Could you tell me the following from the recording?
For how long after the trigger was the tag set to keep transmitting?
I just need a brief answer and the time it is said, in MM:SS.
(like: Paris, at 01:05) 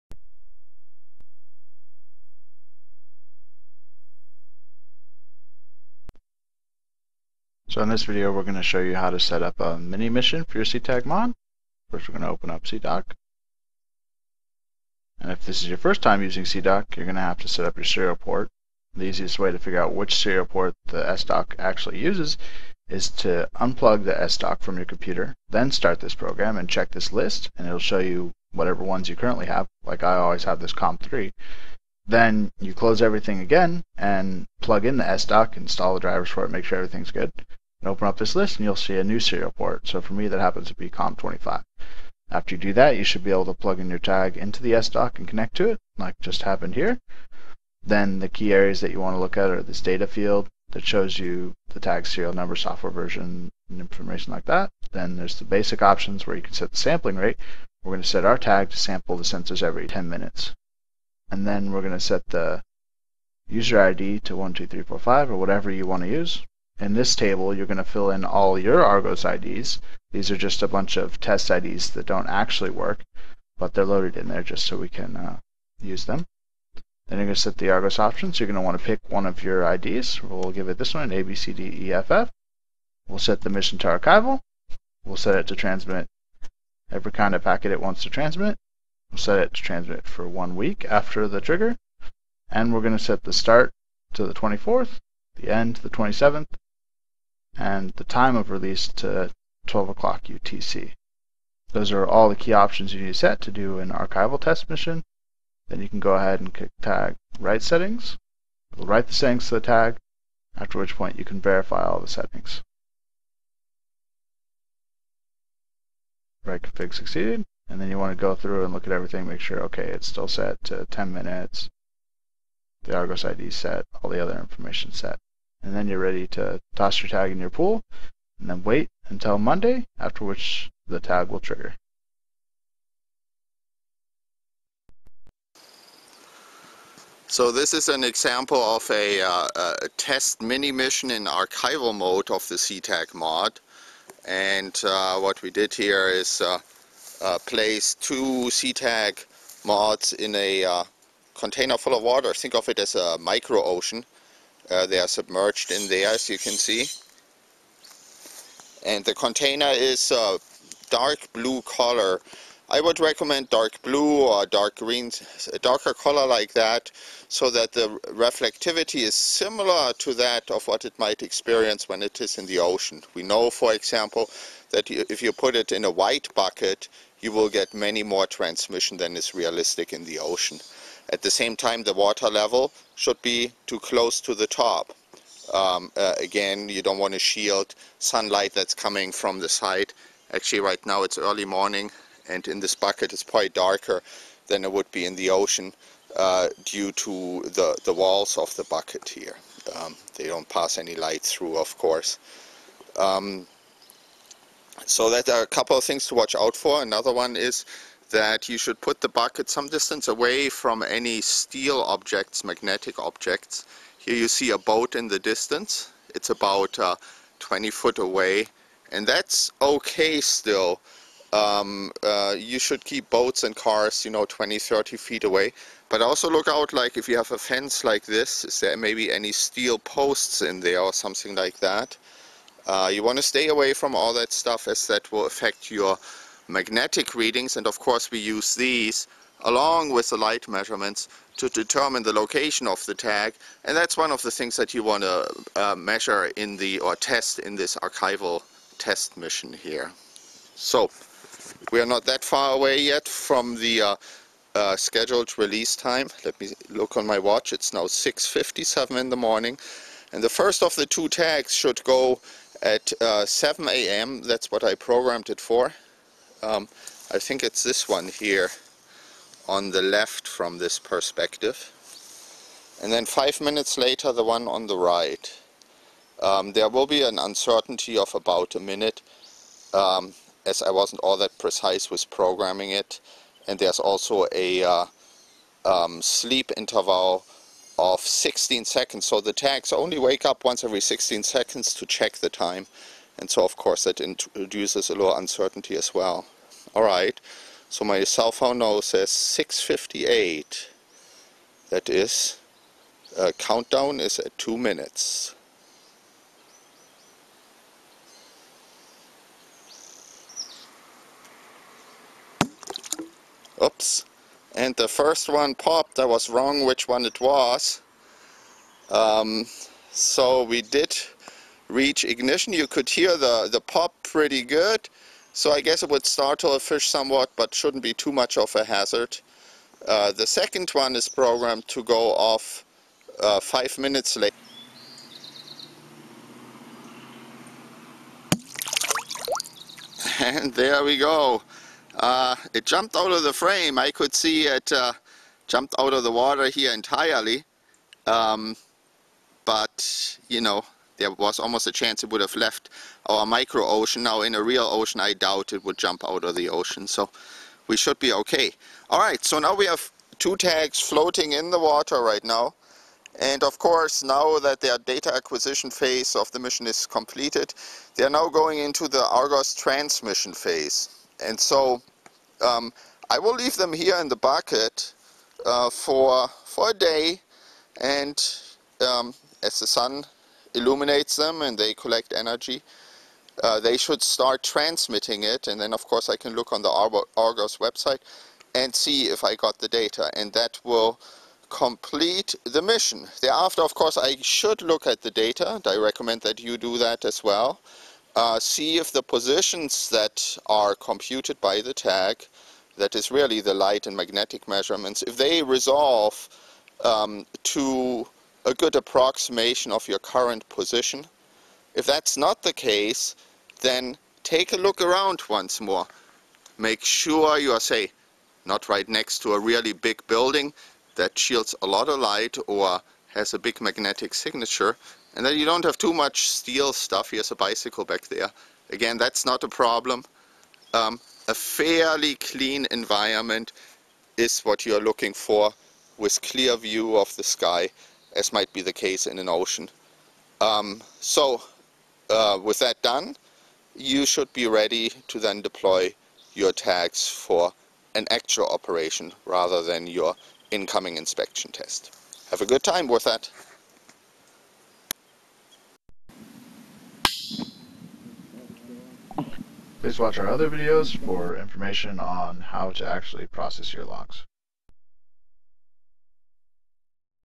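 One week, at 01:30.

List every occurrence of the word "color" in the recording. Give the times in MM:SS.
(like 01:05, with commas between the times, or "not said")
02:41, 02:45.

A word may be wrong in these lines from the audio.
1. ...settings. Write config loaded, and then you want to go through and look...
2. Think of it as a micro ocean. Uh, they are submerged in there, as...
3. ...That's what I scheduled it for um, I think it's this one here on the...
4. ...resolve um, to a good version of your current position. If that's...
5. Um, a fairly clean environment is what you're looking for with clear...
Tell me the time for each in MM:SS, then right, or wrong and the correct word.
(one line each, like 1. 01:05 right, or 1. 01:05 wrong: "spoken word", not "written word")
1. 01:52 wrong: "succeeded", not "loaded"
2. 02:32 right
3. 04:24 wrong: "programmed", not "scheduled"
4. 06:45 wrong: "approximation", not "version"
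5. 07:10 right.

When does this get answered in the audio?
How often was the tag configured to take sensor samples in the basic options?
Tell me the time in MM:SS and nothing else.
00:59.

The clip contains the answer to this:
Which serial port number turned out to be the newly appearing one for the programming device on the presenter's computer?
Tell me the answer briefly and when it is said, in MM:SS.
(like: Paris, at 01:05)
COM25, at 00:40.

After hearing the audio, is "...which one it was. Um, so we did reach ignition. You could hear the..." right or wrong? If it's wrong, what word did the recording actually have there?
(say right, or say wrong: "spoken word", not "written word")
right.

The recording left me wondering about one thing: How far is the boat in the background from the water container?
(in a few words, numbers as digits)
About 20 feet.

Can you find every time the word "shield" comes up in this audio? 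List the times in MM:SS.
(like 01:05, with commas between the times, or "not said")
03:07, 07:01.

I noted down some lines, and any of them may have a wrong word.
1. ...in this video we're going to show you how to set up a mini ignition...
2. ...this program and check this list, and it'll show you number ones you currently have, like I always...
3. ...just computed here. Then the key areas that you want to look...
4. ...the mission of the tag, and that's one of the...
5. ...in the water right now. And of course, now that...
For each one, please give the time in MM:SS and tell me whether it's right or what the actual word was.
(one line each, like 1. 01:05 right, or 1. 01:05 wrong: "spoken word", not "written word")
1. 00:07 wrong: "mission", not "ignition"
2. 00:26 wrong: "whatever", not "number"
3. 00:46 wrong: "happened", not "computed"
4. 04:02 wrong: "location", not "mission"
5. 06:01 right.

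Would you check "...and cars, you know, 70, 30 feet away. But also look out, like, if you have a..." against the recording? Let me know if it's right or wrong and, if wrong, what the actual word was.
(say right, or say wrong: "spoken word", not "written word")
wrong: "20", not "70".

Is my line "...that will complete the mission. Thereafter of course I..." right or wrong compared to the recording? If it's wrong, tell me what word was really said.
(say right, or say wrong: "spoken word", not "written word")
right.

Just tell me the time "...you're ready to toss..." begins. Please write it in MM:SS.
02:05.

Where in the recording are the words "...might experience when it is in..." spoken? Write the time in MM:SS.
02:50.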